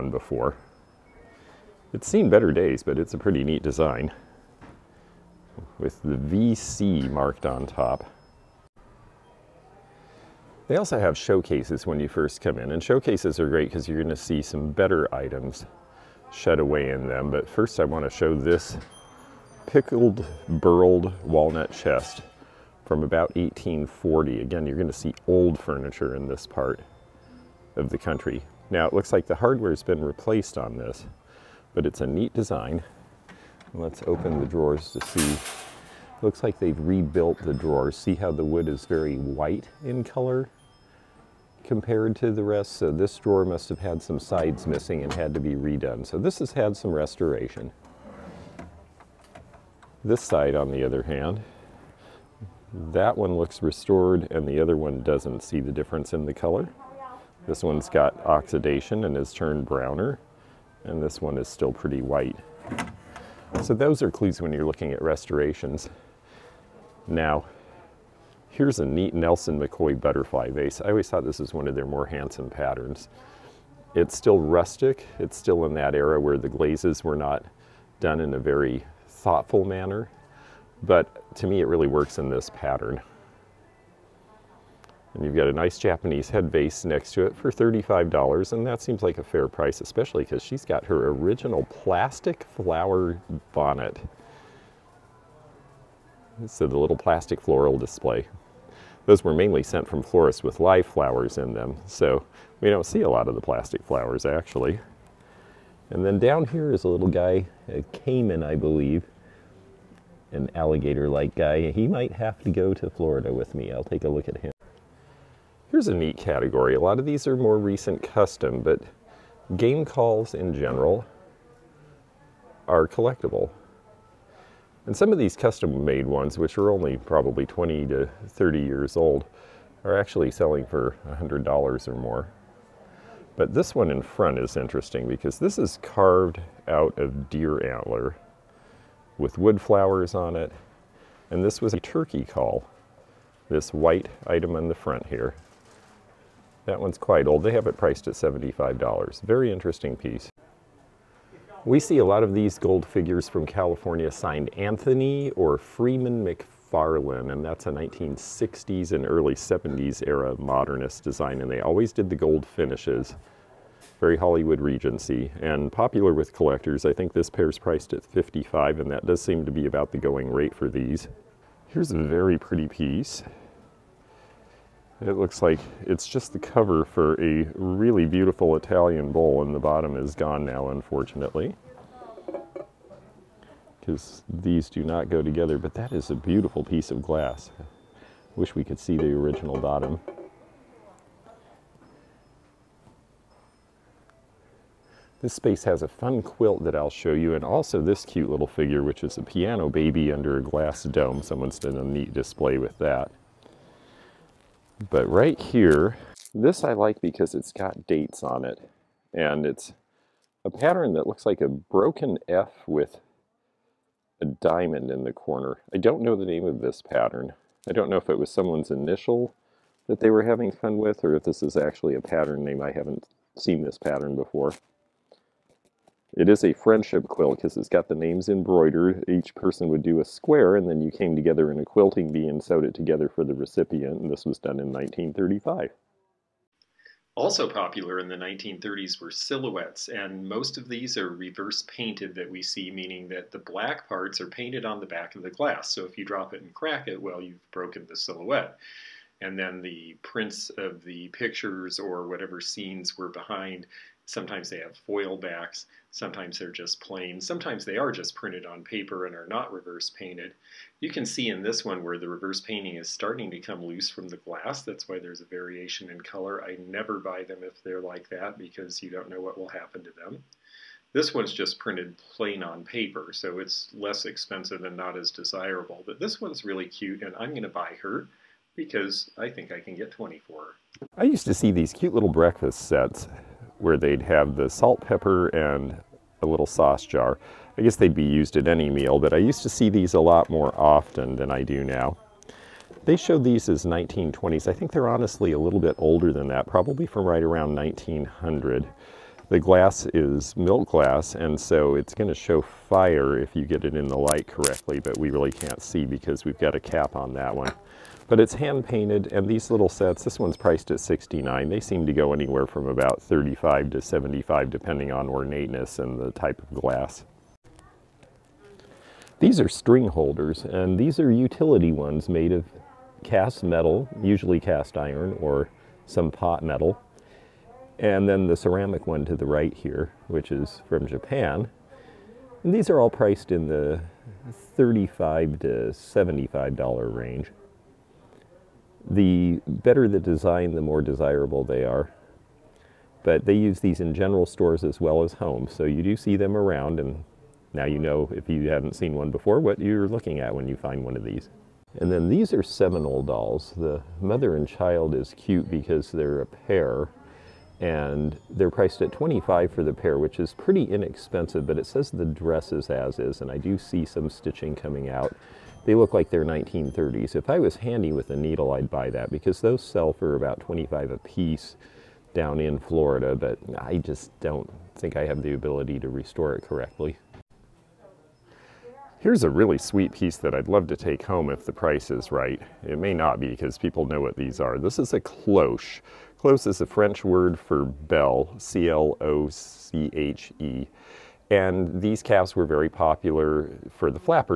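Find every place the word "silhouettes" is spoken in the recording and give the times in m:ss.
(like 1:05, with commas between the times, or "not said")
3:59, 4:07.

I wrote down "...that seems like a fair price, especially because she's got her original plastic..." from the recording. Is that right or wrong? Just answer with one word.
right.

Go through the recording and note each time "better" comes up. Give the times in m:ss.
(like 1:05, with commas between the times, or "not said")
0:02, 0:14, 5:39.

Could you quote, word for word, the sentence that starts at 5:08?
But it's hand painted and these little sets, this one's priced at 69.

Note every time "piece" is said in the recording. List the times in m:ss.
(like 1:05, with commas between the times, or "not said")
2:29, 2:52, 3:06, 6:10, 6:19.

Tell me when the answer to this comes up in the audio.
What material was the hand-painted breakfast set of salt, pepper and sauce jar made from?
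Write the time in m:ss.
5:00.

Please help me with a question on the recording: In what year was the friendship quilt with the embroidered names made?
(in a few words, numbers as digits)
1935.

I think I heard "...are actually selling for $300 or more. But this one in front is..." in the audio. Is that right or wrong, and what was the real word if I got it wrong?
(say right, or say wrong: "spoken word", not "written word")
wrong: "100", not "300".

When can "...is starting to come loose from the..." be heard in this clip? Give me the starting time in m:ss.
4:22.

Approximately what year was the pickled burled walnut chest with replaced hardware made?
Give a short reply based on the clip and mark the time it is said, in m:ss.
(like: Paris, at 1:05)
1840, at 0:23.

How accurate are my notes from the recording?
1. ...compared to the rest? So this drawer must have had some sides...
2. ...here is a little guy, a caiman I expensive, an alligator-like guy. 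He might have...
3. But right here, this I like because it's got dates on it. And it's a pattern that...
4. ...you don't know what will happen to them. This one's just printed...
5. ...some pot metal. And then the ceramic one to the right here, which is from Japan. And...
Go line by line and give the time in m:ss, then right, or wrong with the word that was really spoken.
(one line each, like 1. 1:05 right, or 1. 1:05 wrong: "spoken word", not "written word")
1. 0:41 right
2. 1:46 wrong: "believe", not "expensive"
3. 3:24 right
4. 4:28 right
5. 5:25 right.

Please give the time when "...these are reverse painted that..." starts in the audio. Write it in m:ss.
4:00.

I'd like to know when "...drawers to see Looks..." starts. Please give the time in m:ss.
0:34.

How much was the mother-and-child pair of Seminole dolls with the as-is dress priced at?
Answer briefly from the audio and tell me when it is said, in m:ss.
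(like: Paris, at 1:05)
25, at 5:58.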